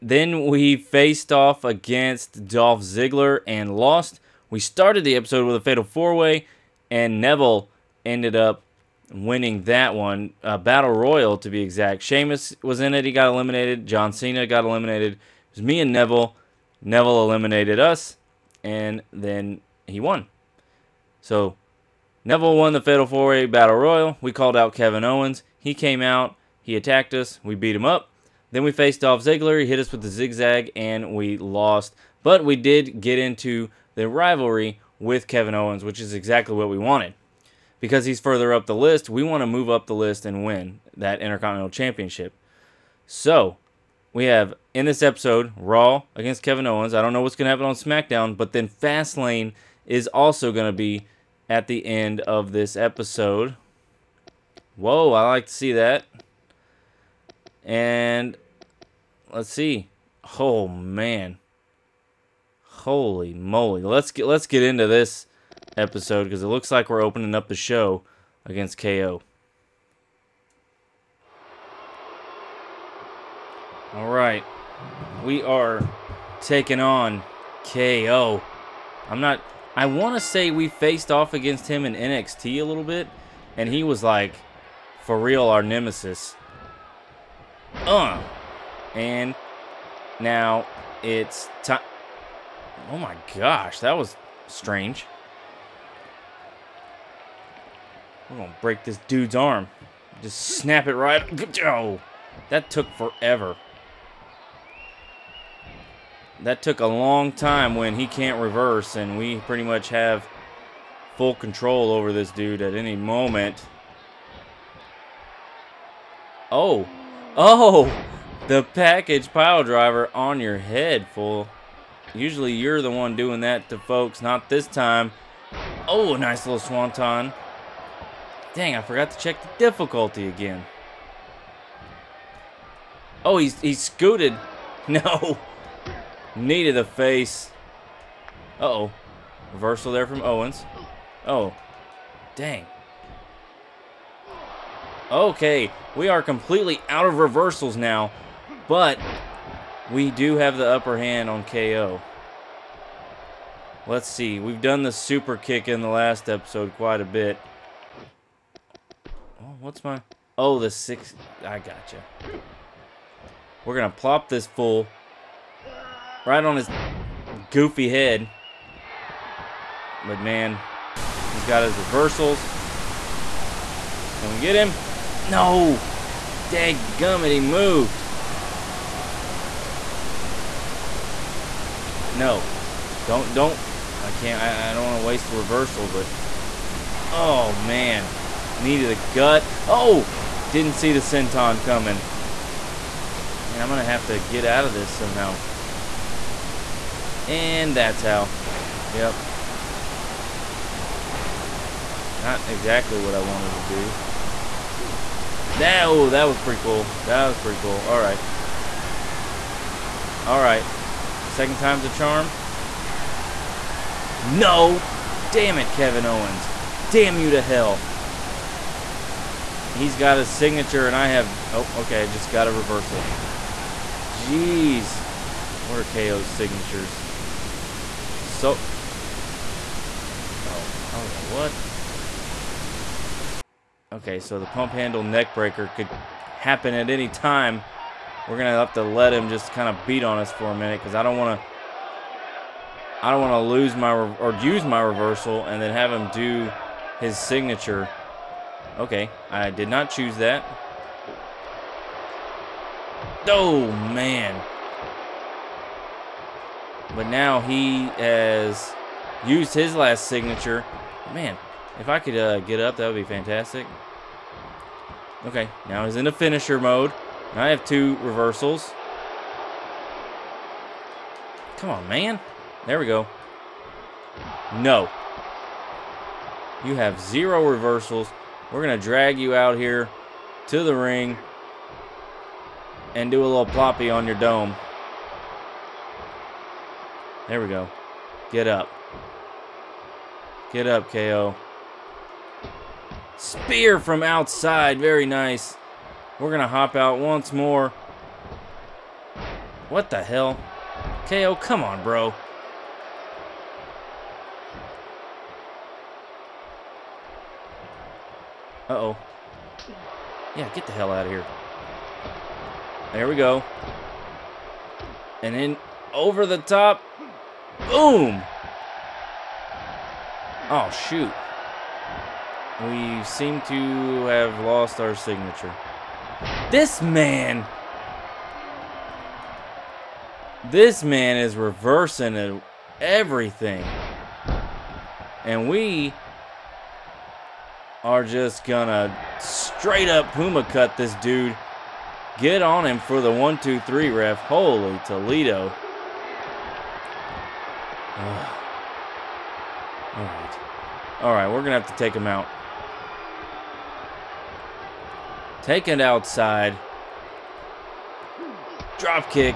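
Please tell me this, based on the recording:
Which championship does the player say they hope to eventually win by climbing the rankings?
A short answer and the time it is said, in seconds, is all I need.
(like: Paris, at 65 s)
Intercontinental Championship, at 41 s.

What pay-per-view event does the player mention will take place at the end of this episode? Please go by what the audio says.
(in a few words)
Fastlane.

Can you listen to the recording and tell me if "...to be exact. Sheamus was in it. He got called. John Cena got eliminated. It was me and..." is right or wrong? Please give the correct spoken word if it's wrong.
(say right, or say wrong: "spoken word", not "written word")
wrong: "eliminated", not "called".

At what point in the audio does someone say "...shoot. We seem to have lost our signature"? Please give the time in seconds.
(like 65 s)
320 s.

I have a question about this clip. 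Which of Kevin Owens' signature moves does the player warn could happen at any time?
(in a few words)
pump handle neck breaker.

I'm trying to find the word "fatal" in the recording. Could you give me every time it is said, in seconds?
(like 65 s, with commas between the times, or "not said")
5 s, 22 s.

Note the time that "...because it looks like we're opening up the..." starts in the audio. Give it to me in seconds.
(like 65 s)
66 s.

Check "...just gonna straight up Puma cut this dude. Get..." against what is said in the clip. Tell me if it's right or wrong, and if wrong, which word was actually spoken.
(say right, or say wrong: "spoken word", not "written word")
right.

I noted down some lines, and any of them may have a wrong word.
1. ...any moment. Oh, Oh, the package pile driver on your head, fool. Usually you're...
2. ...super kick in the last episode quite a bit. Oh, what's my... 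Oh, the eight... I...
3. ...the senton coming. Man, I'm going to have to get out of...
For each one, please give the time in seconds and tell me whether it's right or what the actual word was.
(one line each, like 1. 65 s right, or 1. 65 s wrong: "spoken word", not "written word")
1. 112 s right
2. 154 s wrong: "six", not "eight"
3. 190 s right.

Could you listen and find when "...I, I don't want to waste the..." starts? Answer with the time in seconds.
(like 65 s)
184 s.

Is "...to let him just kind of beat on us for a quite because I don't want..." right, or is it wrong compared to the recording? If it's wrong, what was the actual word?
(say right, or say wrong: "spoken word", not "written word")
wrong: "minute", not "quite".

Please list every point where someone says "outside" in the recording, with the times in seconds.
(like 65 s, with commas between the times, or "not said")
294 s, 355 s.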